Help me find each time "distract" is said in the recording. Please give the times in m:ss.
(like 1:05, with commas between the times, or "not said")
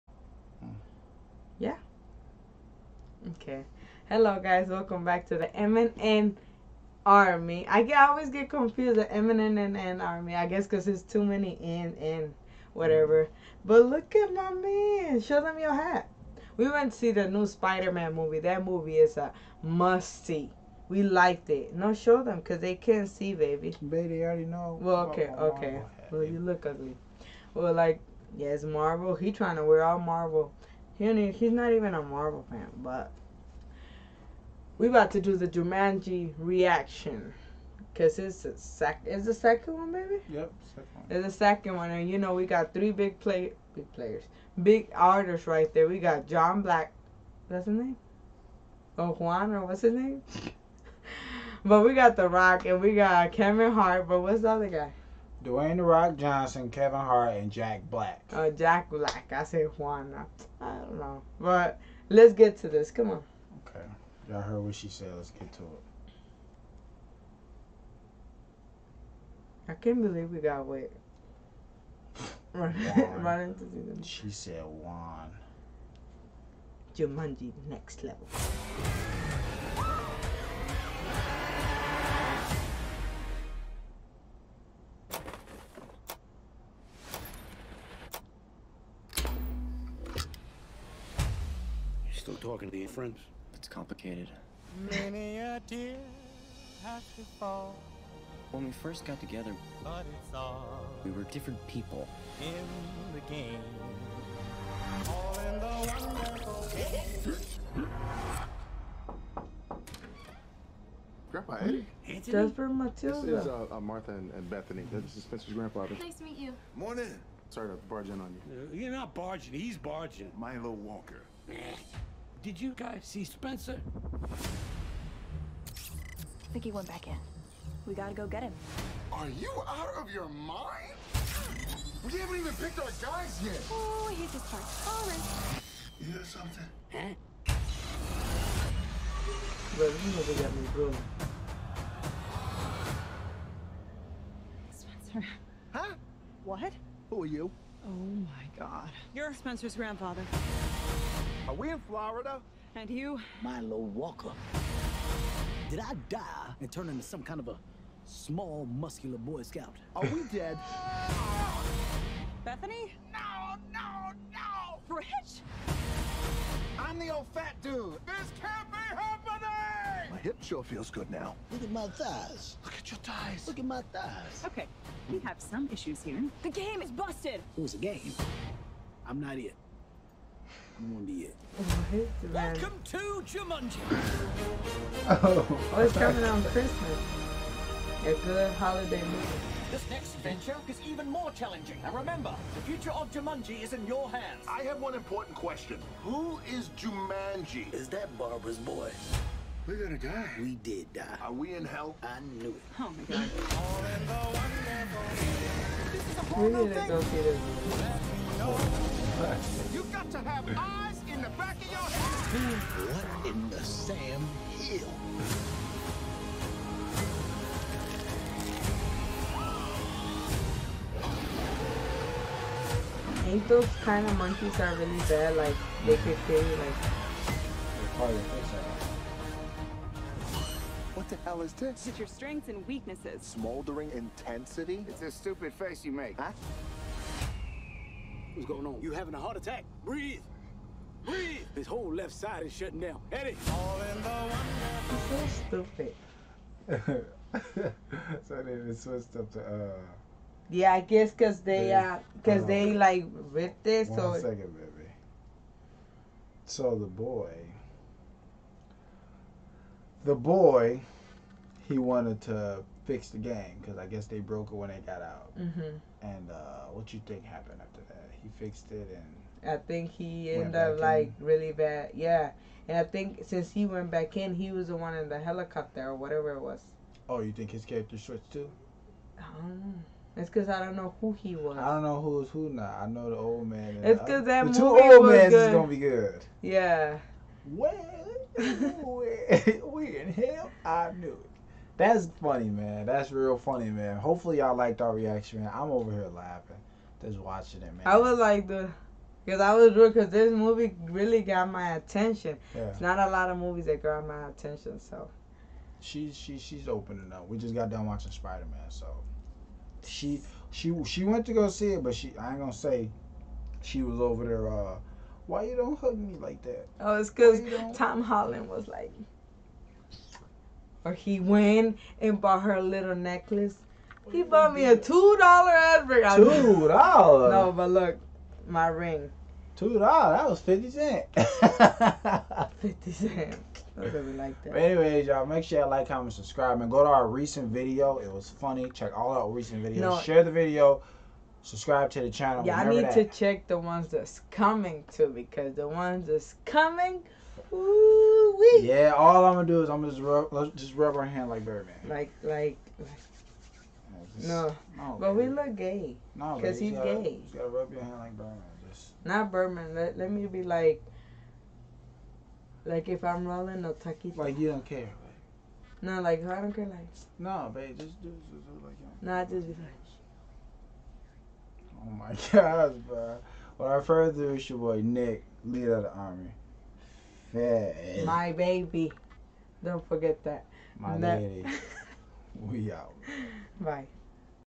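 not said.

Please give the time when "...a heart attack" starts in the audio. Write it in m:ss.
3:59.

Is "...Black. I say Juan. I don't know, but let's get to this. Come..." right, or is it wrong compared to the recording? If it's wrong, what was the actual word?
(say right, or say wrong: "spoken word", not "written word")
right.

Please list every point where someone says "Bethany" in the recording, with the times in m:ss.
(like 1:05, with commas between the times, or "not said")
1:54, 2:42.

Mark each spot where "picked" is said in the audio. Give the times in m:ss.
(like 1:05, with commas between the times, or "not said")
2:12.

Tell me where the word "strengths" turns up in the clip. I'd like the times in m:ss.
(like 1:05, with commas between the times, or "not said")
3:52.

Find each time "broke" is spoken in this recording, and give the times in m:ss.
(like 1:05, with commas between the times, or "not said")
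4:24.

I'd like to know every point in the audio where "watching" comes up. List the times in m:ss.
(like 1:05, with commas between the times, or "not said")
4:57, 5:07.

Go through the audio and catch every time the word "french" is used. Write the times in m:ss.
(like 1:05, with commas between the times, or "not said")
not said.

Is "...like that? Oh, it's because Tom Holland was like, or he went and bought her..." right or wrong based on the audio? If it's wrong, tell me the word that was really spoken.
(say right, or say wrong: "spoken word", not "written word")
right.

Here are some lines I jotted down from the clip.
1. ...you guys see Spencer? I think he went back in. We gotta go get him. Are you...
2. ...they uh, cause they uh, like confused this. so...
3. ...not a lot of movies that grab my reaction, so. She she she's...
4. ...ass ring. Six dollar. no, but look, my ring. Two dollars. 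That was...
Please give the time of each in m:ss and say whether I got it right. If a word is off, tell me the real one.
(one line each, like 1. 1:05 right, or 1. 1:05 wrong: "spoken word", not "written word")
1. 2:02 right
2. 4:11 wrong: "ripped", not "confused"
3. 5:02 wrong: "attention", not "reaction"
4. 5:25 wrong: "Two", not "Six".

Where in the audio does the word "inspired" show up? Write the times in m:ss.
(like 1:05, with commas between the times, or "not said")
not said.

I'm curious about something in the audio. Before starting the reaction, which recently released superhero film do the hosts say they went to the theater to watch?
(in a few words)
Spider-Man.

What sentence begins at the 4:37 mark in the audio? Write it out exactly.
Oh, you think his character switched too?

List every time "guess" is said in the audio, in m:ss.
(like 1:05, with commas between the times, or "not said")
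0:10, 4:10, 4:23.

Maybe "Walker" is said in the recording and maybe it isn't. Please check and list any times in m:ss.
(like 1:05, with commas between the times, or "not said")
2:00, 2:33.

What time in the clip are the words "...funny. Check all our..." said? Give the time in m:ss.
5:38.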